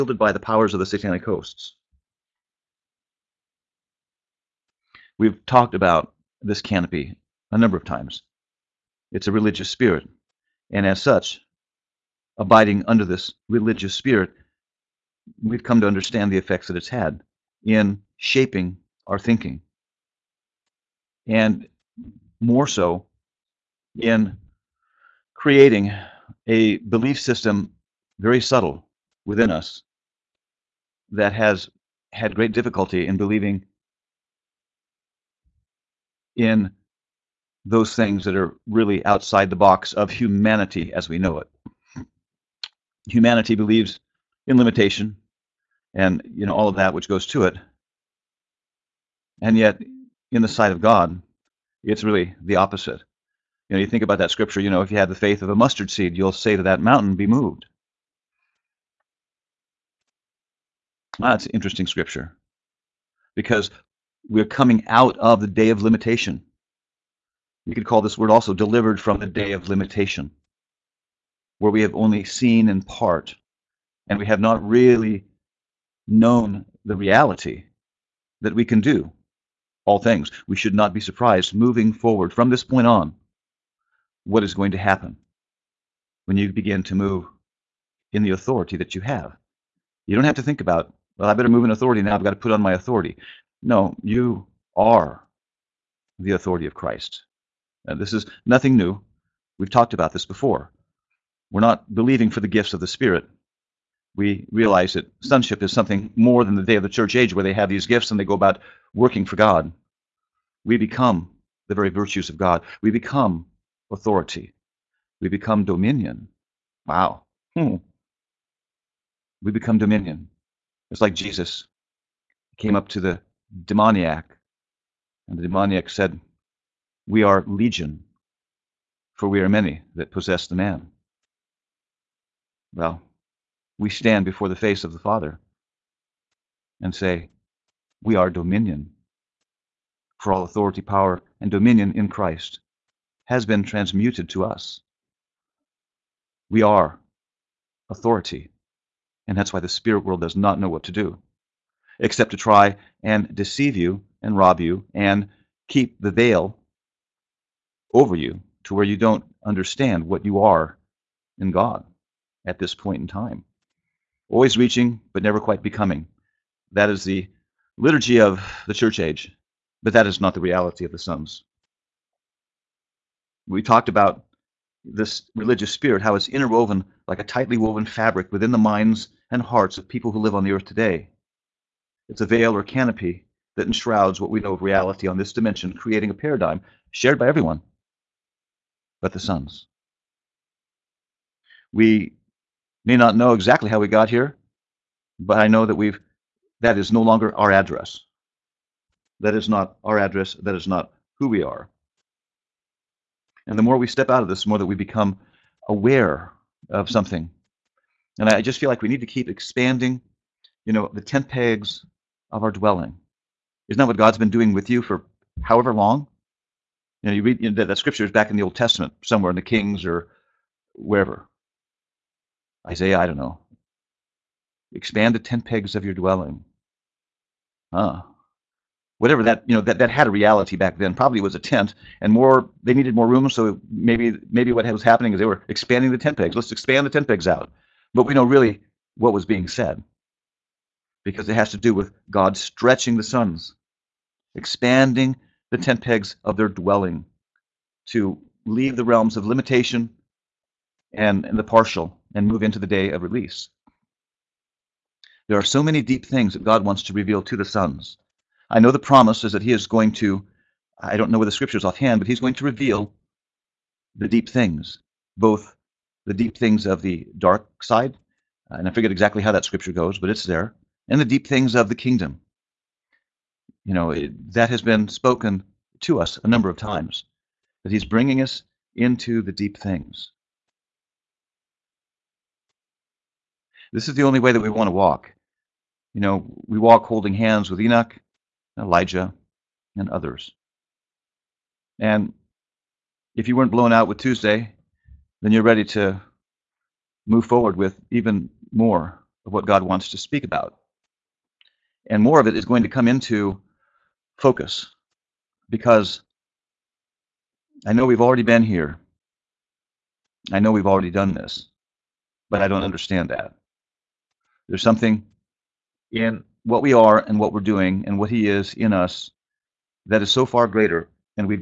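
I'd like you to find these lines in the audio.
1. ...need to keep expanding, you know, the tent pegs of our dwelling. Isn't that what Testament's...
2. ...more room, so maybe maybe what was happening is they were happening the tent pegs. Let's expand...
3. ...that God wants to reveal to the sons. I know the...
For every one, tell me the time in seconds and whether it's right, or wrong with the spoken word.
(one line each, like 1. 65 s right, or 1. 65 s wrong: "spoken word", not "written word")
1. 208 s wrong: "God", not "Testament"
2. 232 s wrong: "expanding", not "happening"
3. 256 s right.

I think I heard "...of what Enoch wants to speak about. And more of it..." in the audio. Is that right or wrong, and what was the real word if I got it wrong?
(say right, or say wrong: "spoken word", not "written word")
wrong: "God", not "Enoch".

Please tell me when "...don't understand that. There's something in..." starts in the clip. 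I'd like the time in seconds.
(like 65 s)
312 s.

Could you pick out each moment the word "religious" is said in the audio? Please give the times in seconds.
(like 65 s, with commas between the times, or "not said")
9 s, 13 s, 175 s.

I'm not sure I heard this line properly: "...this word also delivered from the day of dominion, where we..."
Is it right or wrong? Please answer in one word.
wrong.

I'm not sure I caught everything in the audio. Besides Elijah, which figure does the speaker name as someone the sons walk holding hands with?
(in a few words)
Enoch.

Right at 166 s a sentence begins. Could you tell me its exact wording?
That is the liturgy of the church age, but that is not the reality of the sums.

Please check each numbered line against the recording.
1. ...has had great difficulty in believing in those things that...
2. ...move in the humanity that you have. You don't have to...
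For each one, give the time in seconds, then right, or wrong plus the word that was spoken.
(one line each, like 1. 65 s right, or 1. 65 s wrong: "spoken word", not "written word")
1. 31 s right
2. 86 s wrong: "authority", not "humanity".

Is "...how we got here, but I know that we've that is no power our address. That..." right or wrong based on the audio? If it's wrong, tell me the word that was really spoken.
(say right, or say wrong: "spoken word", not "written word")
wrong: "longer", not "power".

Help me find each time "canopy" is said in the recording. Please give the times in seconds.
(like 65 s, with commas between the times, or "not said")
6 s, 182 s.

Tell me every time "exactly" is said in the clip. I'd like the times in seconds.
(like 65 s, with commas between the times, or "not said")
193 s, 268 s.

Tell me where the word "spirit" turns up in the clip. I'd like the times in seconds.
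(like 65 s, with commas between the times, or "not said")
9 s, 13 s, 102 s, 149 s, 175 s.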